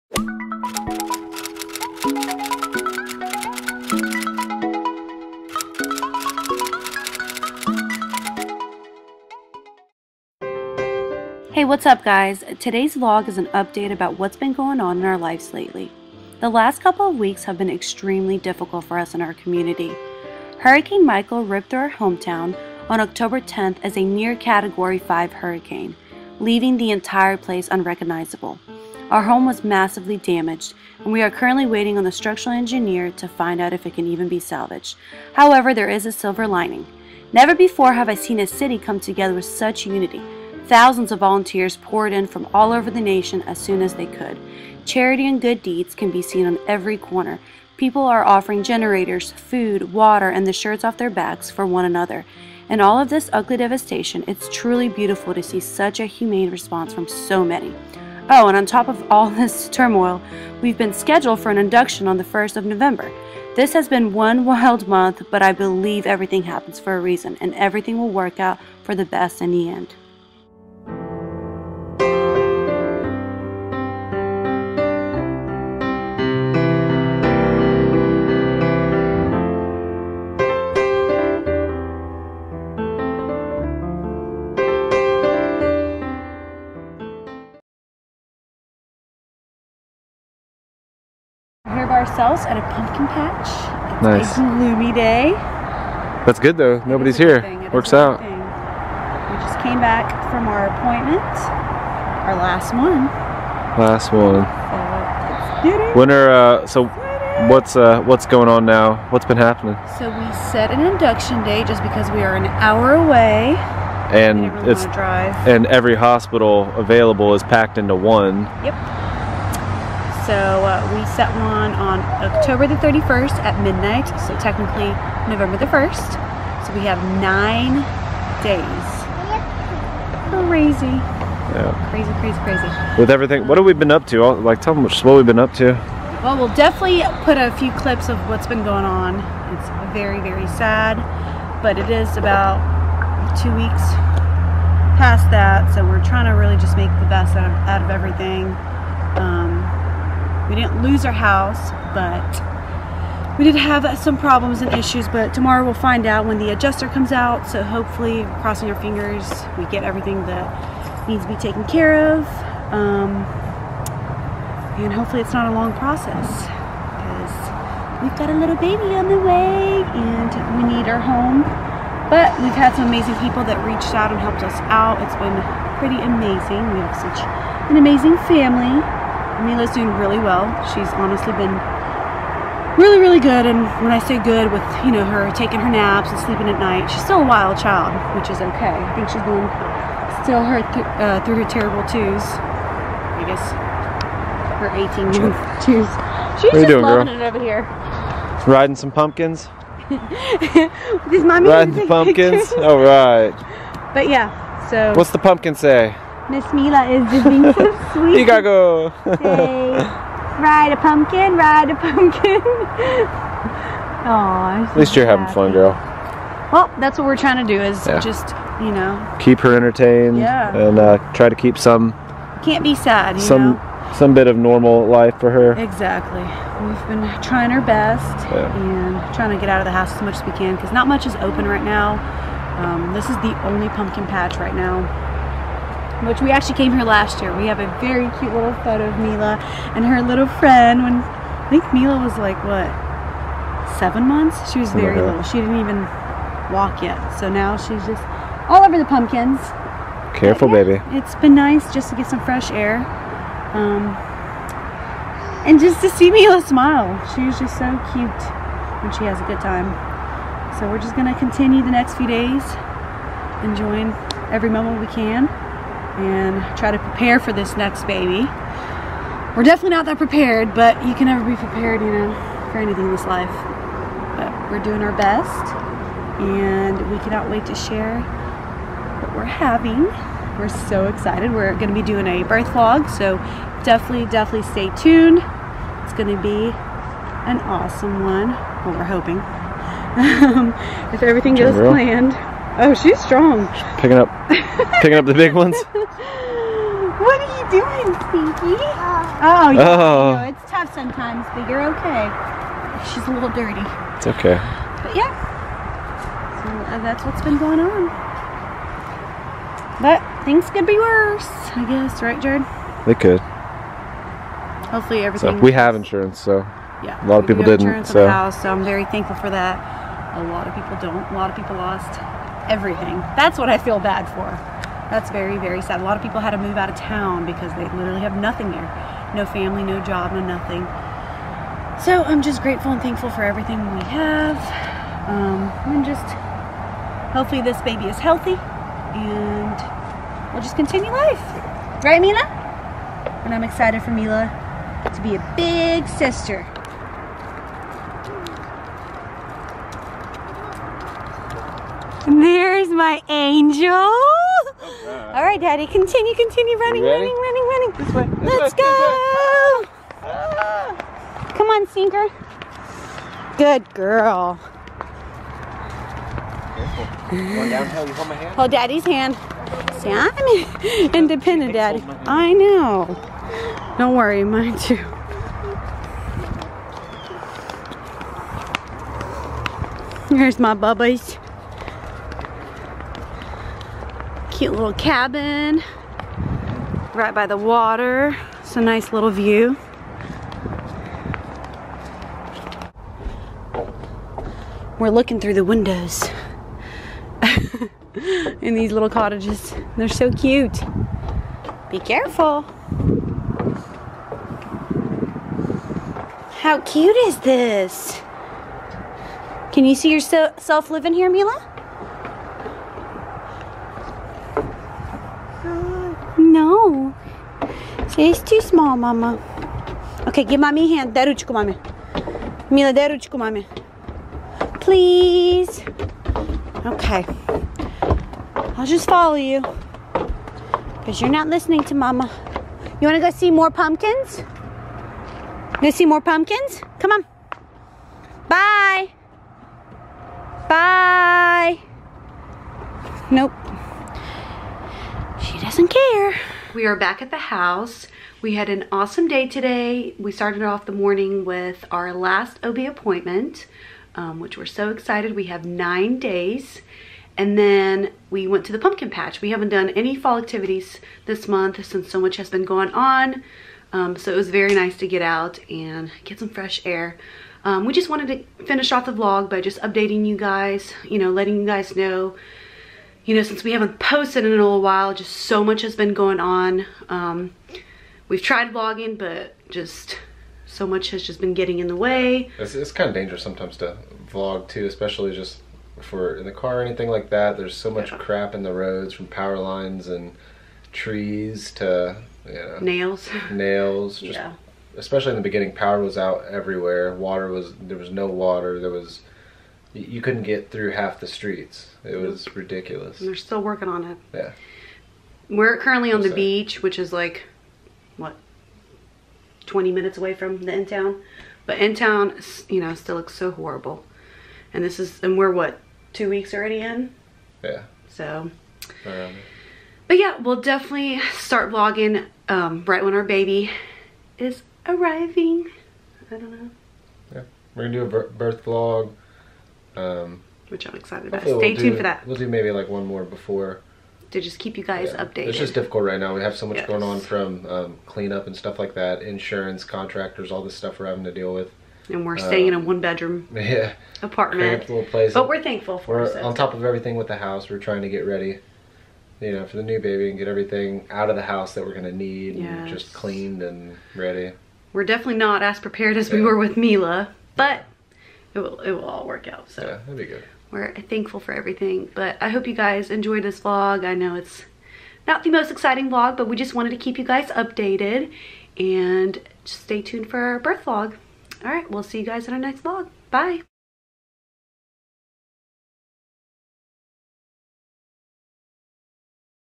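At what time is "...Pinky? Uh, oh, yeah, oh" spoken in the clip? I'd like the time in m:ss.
4:58.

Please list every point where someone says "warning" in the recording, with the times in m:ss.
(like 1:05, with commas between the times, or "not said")
not said.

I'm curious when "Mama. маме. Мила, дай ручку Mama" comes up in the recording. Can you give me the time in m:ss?
7:00.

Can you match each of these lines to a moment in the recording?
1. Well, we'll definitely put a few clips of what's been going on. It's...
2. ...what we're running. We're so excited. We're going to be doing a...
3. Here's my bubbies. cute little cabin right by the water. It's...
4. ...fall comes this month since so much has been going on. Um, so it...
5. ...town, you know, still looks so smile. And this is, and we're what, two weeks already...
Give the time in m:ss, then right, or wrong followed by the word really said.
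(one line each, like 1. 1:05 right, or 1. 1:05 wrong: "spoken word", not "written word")
1. 2:16 right
2. 4:39 wrong: "having", not "running"
3. 6:20 right
4. 7:39 wrong: "activities", not "comes"
5. 8:31 wrong: "horrible", not "smile".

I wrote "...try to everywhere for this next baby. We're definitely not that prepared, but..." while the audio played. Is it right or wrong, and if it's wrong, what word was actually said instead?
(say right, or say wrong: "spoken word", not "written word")
wrong: "prepare", not "everywhere".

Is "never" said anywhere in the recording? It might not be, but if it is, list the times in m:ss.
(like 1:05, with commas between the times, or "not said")
0:37, 4:31.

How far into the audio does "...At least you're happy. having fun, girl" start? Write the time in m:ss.
3:34.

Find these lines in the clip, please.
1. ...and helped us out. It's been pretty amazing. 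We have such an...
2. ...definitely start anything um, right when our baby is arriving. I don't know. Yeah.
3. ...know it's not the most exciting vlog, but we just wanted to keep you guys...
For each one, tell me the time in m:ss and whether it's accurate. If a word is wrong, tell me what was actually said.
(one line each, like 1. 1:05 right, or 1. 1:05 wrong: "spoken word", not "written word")
1. 2:54 right
2. 8:40 wrong: "vlogging", not "anything"
3. 9:23 right.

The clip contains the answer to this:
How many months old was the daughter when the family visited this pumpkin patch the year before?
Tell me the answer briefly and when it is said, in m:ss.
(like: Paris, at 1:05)
7, at 4:03.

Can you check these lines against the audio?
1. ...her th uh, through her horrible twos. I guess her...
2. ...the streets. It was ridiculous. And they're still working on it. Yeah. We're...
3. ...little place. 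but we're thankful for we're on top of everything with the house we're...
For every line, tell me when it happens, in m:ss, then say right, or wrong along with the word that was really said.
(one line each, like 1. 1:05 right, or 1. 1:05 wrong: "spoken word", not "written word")
1. 3:10 wrong: "terrible", not "horrible"
2. 8:20 right
3. 9:04 right.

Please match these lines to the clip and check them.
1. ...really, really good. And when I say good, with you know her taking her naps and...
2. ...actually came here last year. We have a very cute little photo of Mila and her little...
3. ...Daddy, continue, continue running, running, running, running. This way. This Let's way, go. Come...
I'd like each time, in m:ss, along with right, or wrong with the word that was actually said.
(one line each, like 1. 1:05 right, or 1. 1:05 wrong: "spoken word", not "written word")
1. 3:02 right
2. 3:56 right
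3. 5:55 right.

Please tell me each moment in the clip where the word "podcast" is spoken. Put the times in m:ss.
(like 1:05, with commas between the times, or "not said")
not said.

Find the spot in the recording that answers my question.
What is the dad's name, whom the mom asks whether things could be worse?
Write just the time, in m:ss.
5:12.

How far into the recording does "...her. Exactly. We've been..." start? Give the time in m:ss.
3:45.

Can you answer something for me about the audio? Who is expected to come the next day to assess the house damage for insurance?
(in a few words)
the adjuster.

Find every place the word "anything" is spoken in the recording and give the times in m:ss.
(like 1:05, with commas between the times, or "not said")
4:32, 8:06.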